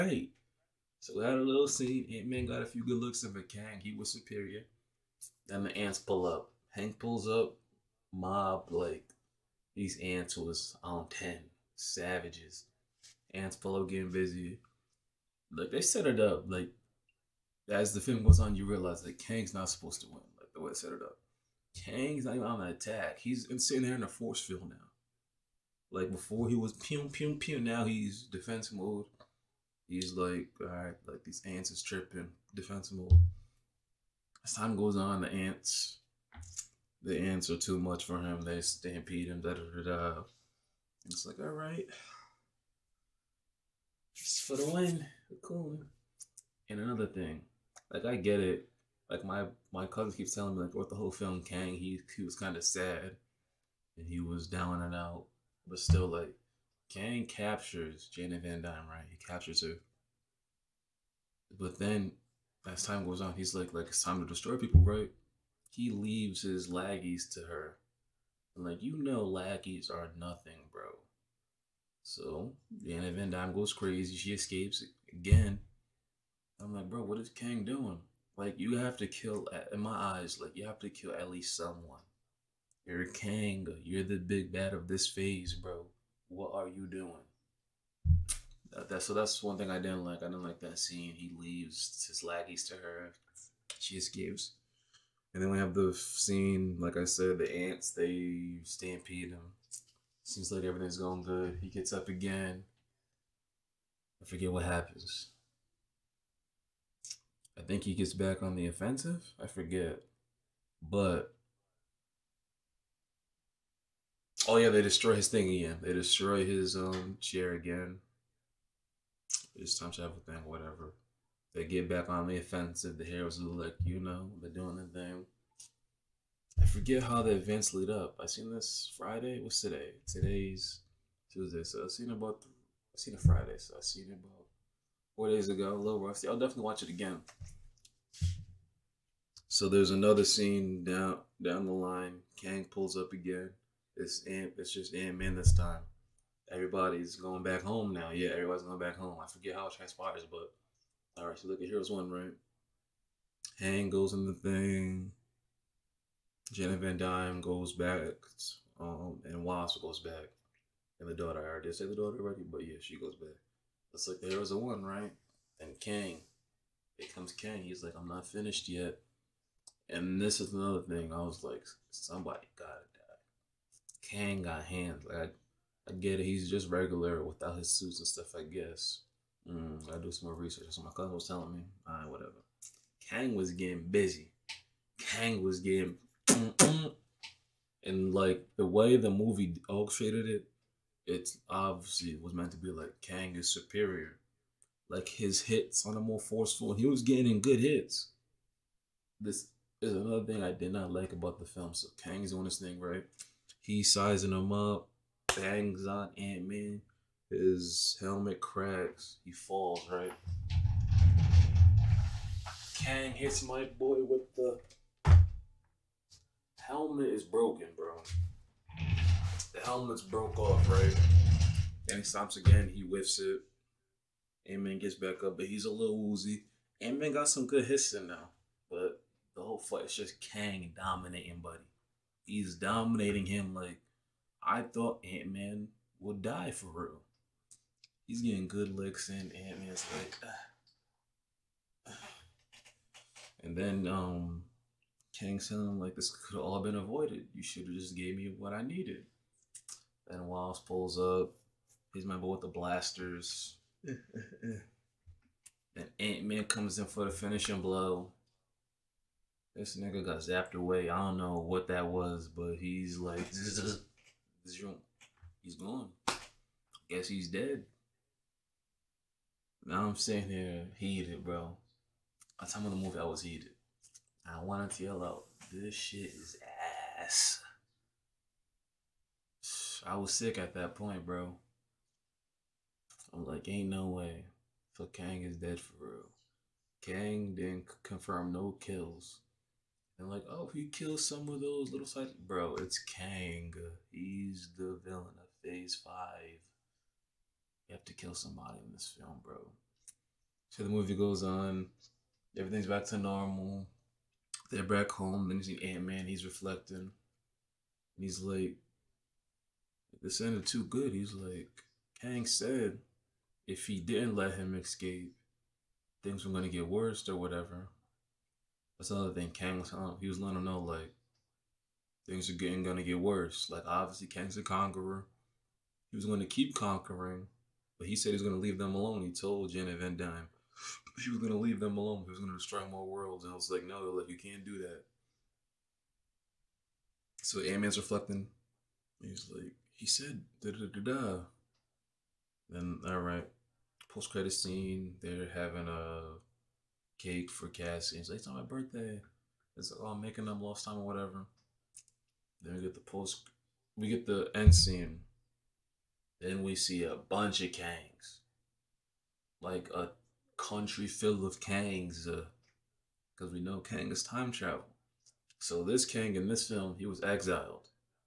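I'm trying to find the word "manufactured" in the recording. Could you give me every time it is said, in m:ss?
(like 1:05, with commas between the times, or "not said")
not said.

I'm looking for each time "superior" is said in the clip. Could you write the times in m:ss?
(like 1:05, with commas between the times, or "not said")
0:04, 3:13.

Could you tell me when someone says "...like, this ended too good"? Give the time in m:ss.
5:08.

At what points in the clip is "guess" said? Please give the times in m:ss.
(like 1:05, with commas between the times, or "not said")
2:58, 4:26.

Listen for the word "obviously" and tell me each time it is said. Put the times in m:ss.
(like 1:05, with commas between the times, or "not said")
3:11, 5:23.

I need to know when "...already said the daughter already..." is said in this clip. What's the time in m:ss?
2:41.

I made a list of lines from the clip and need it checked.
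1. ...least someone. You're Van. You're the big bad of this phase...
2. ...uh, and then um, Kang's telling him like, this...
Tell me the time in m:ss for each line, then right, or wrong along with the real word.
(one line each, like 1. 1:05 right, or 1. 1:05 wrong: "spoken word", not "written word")
1. 1:21 wrong: "Kang", not "Van"
2. 4:01 right.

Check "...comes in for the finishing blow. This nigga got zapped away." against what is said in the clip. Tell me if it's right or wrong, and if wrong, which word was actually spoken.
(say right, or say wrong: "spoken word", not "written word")
right.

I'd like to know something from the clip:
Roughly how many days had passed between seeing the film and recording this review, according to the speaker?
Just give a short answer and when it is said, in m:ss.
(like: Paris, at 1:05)
4, at 2:15.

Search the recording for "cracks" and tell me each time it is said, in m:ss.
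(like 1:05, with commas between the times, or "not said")
3:28.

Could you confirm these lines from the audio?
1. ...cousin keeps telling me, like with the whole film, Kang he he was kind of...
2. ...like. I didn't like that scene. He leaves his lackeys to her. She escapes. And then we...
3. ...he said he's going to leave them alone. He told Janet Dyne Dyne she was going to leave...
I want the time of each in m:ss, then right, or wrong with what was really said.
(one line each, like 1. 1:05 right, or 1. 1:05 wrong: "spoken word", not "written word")
1. 0:49 right
2. 1:30 right
3. 5:27 wrong: "Van", not "Dyne".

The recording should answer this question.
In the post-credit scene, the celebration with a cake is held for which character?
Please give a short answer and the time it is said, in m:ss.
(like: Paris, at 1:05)
Cassie, at 5:47.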